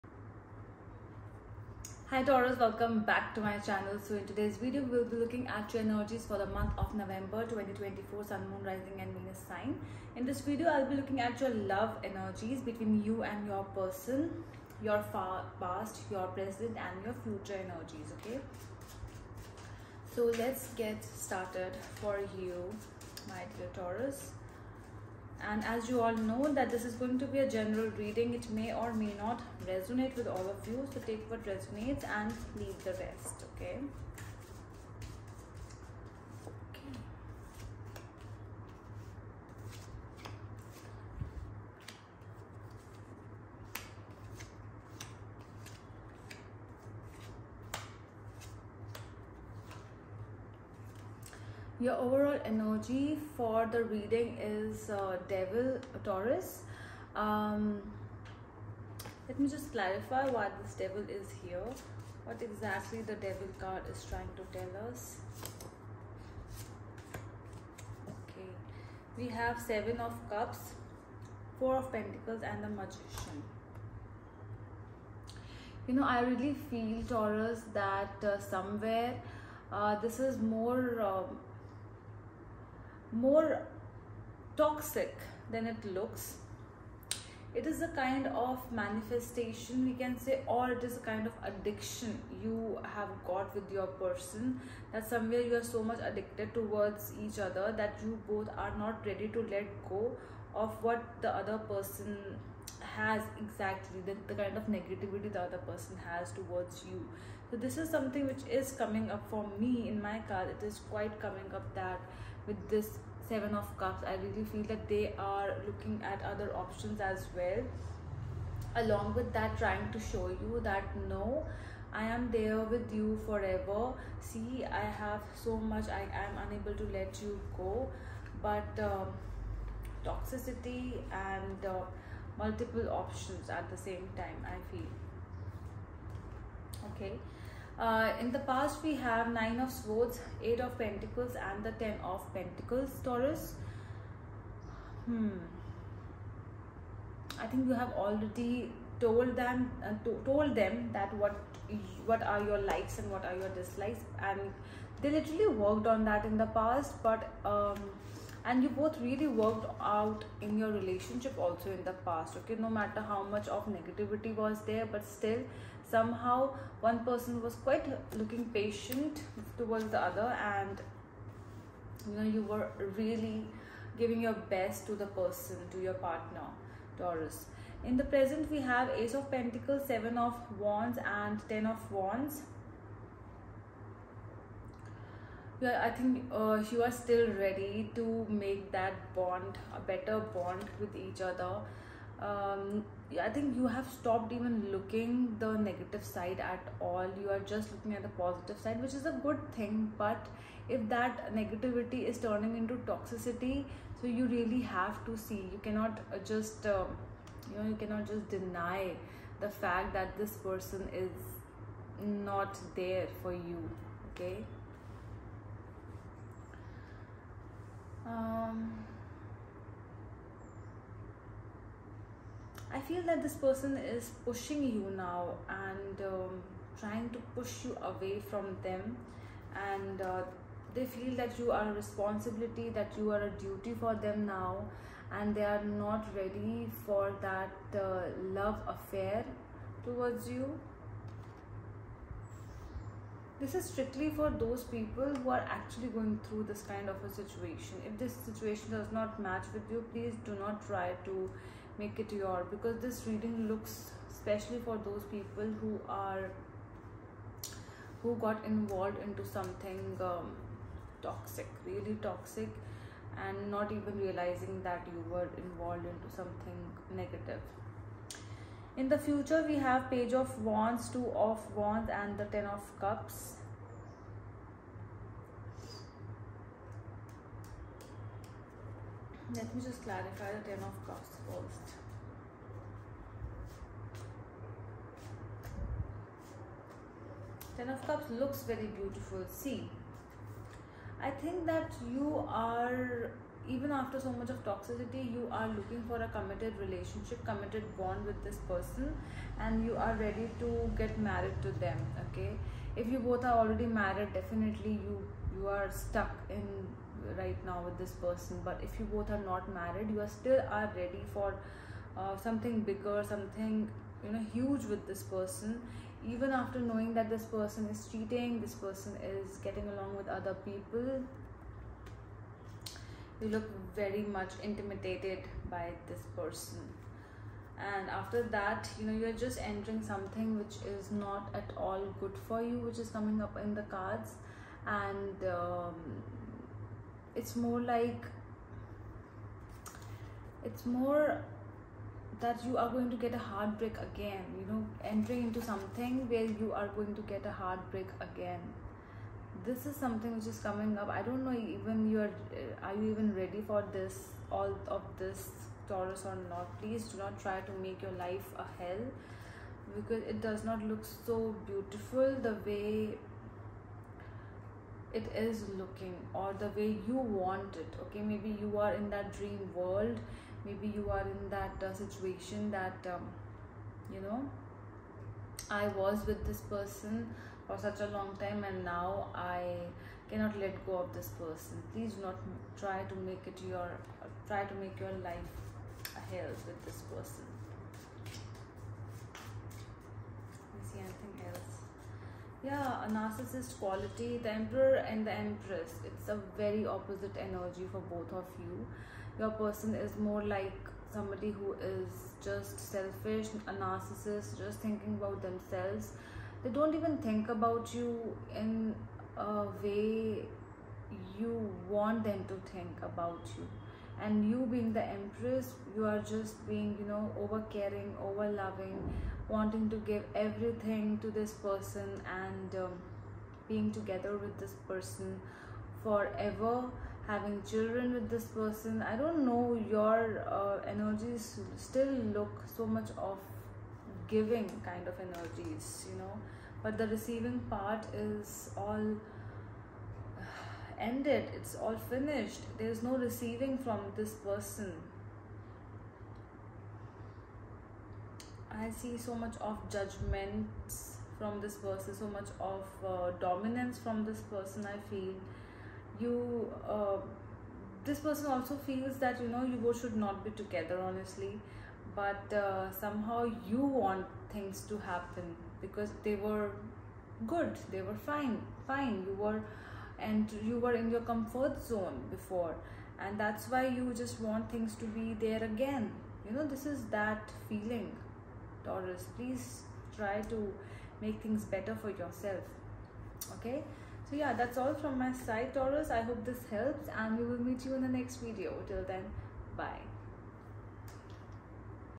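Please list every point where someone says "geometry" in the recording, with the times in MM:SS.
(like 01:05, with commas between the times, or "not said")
not said.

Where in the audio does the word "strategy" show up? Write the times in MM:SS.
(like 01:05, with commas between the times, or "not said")
not said.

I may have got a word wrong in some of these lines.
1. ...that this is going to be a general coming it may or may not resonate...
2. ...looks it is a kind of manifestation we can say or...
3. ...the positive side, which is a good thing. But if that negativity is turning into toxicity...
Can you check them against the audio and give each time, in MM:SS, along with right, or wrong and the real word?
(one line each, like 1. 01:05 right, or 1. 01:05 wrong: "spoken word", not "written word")
1. 00:26 wrong: "reading", not "coming"
2. 01:25 right
3. 03:18 right.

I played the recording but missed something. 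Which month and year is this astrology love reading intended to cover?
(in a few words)
November 2024.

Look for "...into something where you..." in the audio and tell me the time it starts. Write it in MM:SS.
05:45.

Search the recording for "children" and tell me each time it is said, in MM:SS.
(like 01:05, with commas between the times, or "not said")
07:07.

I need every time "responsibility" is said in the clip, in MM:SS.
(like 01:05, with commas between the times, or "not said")
03:51.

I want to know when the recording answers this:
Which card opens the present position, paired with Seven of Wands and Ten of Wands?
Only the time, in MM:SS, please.
02:59.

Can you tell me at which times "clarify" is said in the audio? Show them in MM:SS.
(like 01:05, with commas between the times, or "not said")
00:59, 04:39.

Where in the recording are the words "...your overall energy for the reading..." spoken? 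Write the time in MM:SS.
00:51.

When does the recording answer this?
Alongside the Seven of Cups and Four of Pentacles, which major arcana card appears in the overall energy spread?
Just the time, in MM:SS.
01:12.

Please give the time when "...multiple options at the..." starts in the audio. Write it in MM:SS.
02:12.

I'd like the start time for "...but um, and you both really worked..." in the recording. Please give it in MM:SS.
02:37.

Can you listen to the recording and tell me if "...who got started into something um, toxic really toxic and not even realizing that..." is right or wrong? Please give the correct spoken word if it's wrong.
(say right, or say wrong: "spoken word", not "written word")
wrong: "involved", not "started".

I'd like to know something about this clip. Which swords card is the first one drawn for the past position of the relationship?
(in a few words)
9 of Swords.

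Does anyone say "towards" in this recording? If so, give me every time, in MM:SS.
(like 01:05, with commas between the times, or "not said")
01:36, 01:46, 02:49, 03:59.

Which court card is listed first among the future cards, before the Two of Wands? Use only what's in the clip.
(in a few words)
Page of Wands.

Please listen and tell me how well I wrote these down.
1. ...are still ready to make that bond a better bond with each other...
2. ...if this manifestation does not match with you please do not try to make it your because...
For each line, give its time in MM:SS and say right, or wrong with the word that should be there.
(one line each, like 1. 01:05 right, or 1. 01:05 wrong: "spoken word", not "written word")
1. 03:06 right
2. 04:07 wrong: "situation", not "manifestation".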